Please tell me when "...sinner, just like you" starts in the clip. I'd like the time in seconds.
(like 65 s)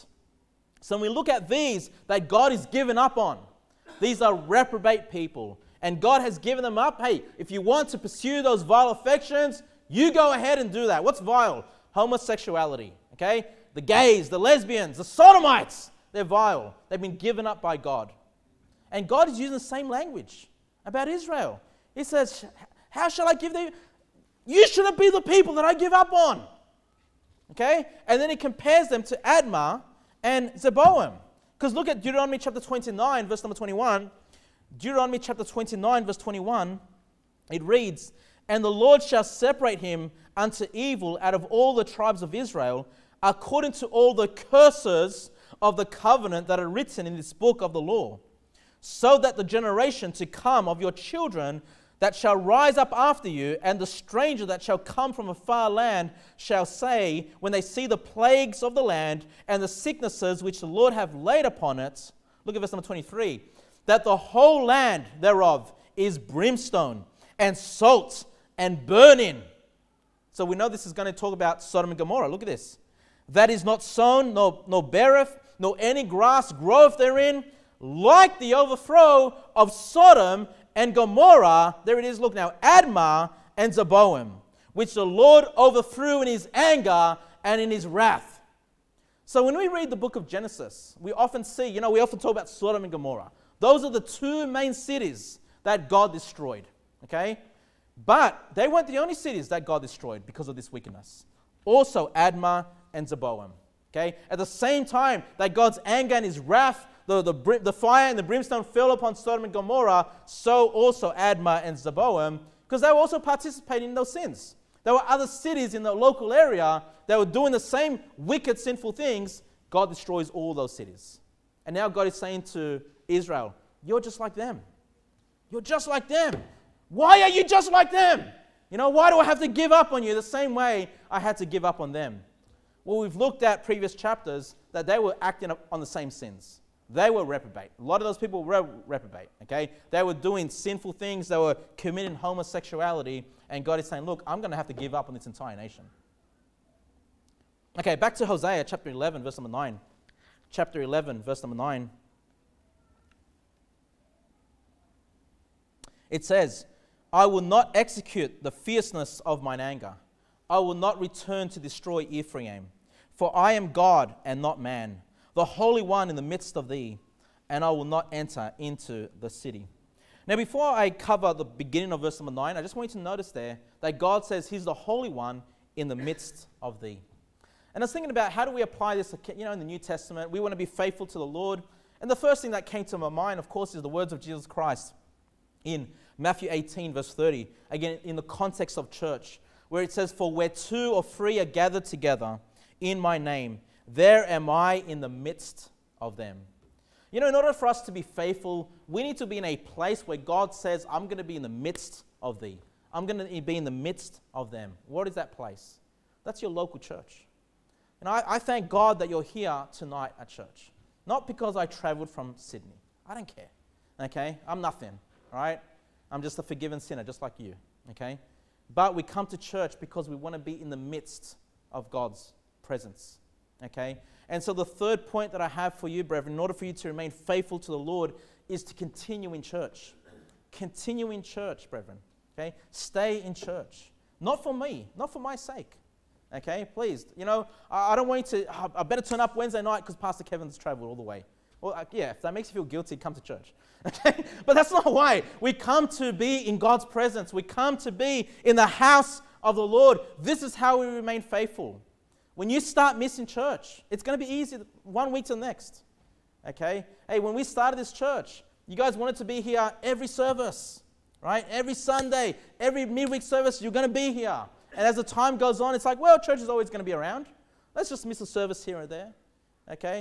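216 s.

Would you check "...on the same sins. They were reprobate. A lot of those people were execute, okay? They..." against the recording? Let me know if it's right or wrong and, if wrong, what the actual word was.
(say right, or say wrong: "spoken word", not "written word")
wrong: "reprobate", not "execute".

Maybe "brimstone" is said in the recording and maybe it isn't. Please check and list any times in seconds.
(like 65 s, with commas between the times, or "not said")
66 s, 108 s.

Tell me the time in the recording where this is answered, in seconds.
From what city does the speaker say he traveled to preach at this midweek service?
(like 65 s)
212 s.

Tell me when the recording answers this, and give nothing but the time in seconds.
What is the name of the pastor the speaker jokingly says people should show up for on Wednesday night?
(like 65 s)
239 s.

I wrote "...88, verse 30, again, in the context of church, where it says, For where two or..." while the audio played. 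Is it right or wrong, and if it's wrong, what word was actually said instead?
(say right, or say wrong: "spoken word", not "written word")
wrong: "18", not "88".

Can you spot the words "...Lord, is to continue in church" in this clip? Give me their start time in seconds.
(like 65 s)
227 s.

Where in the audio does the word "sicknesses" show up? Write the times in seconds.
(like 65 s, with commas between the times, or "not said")
59 s.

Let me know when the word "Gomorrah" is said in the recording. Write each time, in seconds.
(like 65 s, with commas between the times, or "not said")
71 s, 80 s, 92 s, 109 s.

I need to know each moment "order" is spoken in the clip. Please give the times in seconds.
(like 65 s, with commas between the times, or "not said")
197 s, 226 s.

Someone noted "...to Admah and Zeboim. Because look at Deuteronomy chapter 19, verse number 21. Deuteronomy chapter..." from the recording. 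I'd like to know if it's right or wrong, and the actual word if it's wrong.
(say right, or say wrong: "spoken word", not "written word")
wrong: "29", not "19".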